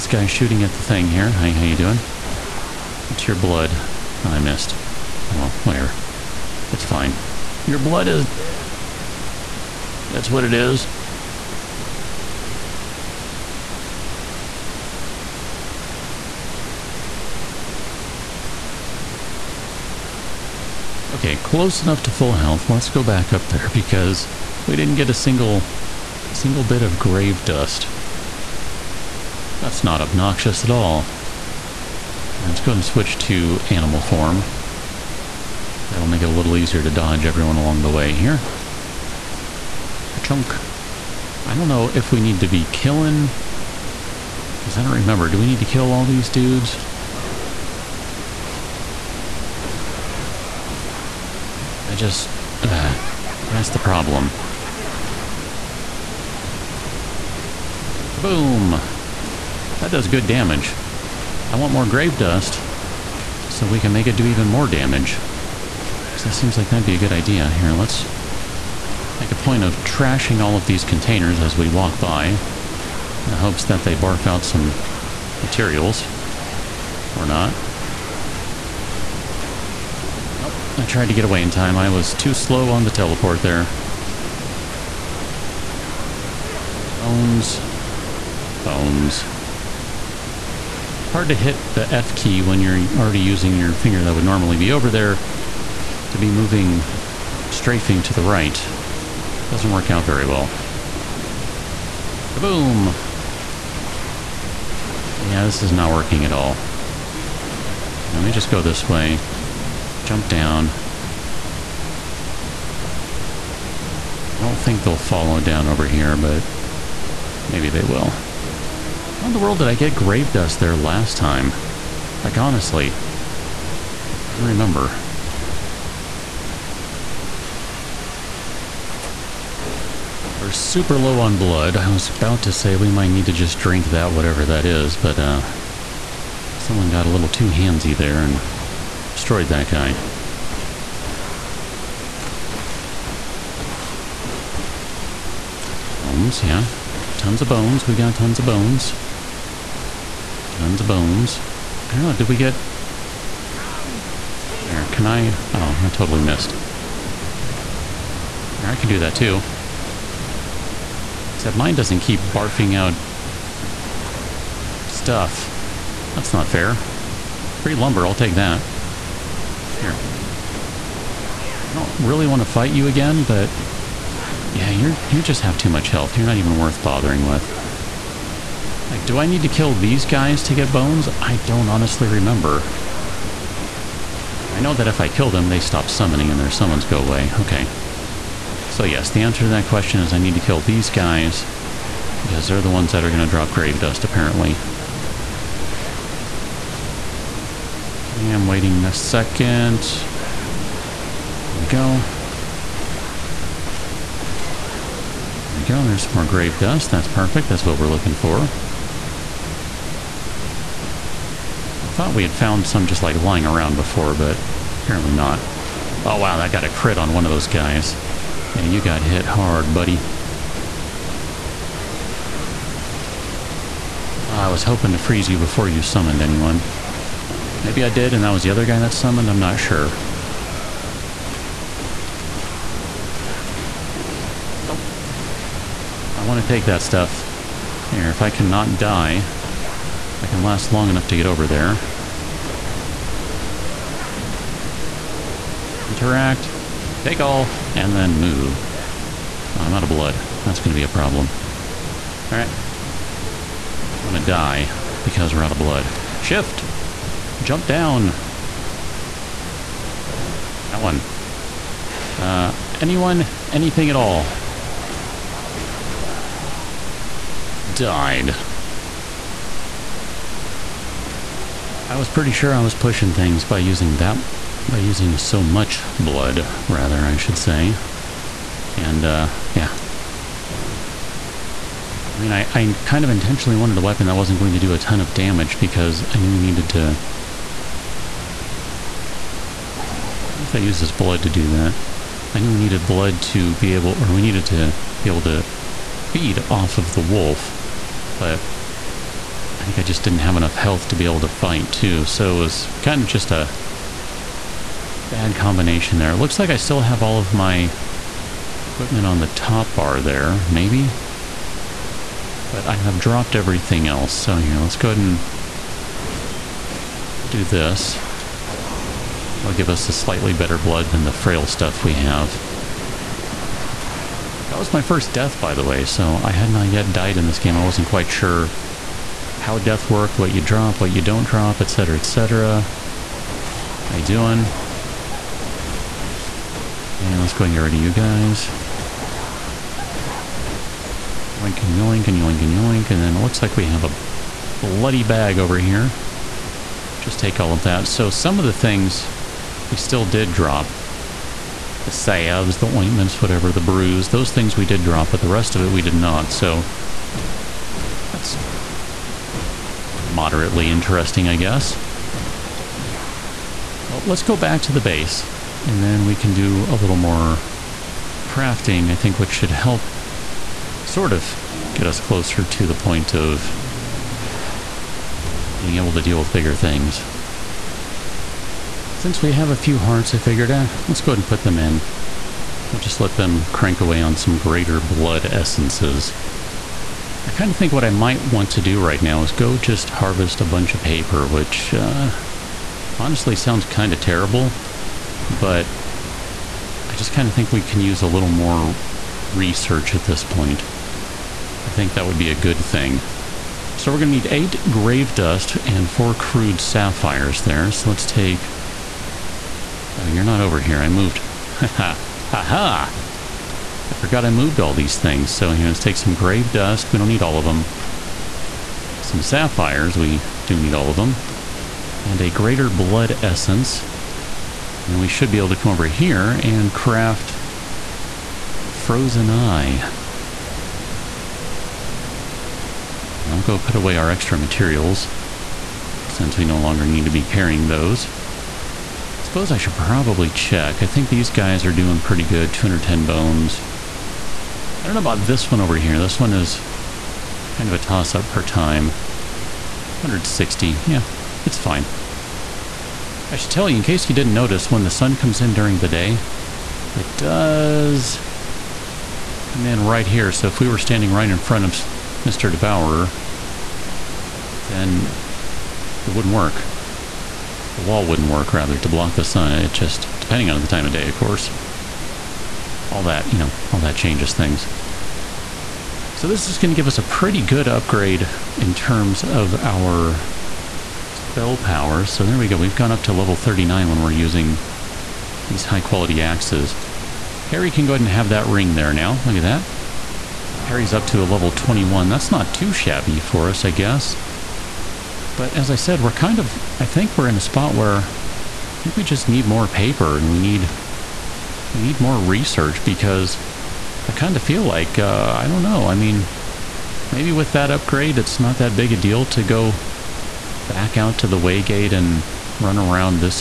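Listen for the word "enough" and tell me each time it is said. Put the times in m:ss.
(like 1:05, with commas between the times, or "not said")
0:21, 4:00, 5:00.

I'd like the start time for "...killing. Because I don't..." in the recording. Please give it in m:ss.
0:42.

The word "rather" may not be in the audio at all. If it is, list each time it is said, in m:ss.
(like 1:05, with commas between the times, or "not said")
4:36, 7:48.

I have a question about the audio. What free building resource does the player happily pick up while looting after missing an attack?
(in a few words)
Lumber.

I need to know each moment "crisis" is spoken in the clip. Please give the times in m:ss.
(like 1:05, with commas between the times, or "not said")
not said.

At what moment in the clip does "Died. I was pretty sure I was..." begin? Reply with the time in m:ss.
4:27.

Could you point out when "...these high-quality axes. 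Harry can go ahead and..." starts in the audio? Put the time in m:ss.
8:05.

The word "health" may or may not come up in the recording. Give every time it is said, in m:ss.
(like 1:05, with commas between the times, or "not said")
0:22, 2:55, 5:00.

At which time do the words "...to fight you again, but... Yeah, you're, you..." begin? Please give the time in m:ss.
2:52.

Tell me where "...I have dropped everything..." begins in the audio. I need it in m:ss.
5:12.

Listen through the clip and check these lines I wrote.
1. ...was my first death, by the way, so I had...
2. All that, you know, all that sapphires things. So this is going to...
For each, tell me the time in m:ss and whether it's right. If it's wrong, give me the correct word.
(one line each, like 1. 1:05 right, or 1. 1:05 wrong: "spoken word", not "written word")
1. 5:24 right
2. 7:52 wrong: "changes", not "sapphires".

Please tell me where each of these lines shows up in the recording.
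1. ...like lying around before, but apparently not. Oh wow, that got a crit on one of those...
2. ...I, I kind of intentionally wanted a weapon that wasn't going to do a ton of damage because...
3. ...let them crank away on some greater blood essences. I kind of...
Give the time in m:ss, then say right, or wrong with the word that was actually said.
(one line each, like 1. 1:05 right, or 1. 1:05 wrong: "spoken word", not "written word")
1. 3:33 right
2. 4:42 right
3. 6:22 right.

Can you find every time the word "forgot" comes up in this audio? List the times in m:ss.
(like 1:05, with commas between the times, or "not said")
6:53.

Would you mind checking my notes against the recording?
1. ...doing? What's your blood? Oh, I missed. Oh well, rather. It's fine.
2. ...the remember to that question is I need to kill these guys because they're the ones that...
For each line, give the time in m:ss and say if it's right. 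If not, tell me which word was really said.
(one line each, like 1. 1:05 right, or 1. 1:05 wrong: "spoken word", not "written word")
1. 0:01 wrong: "whatever", not "rather"
2. 3:09 wrong: "answer", not "remember".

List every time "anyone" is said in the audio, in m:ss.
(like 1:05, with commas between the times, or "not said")
3:46, 4:22.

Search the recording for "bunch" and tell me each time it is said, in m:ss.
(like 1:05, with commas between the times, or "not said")
6:30.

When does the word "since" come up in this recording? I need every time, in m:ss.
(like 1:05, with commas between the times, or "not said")
6:18, 7:16.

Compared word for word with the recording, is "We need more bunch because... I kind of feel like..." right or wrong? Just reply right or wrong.
wrong.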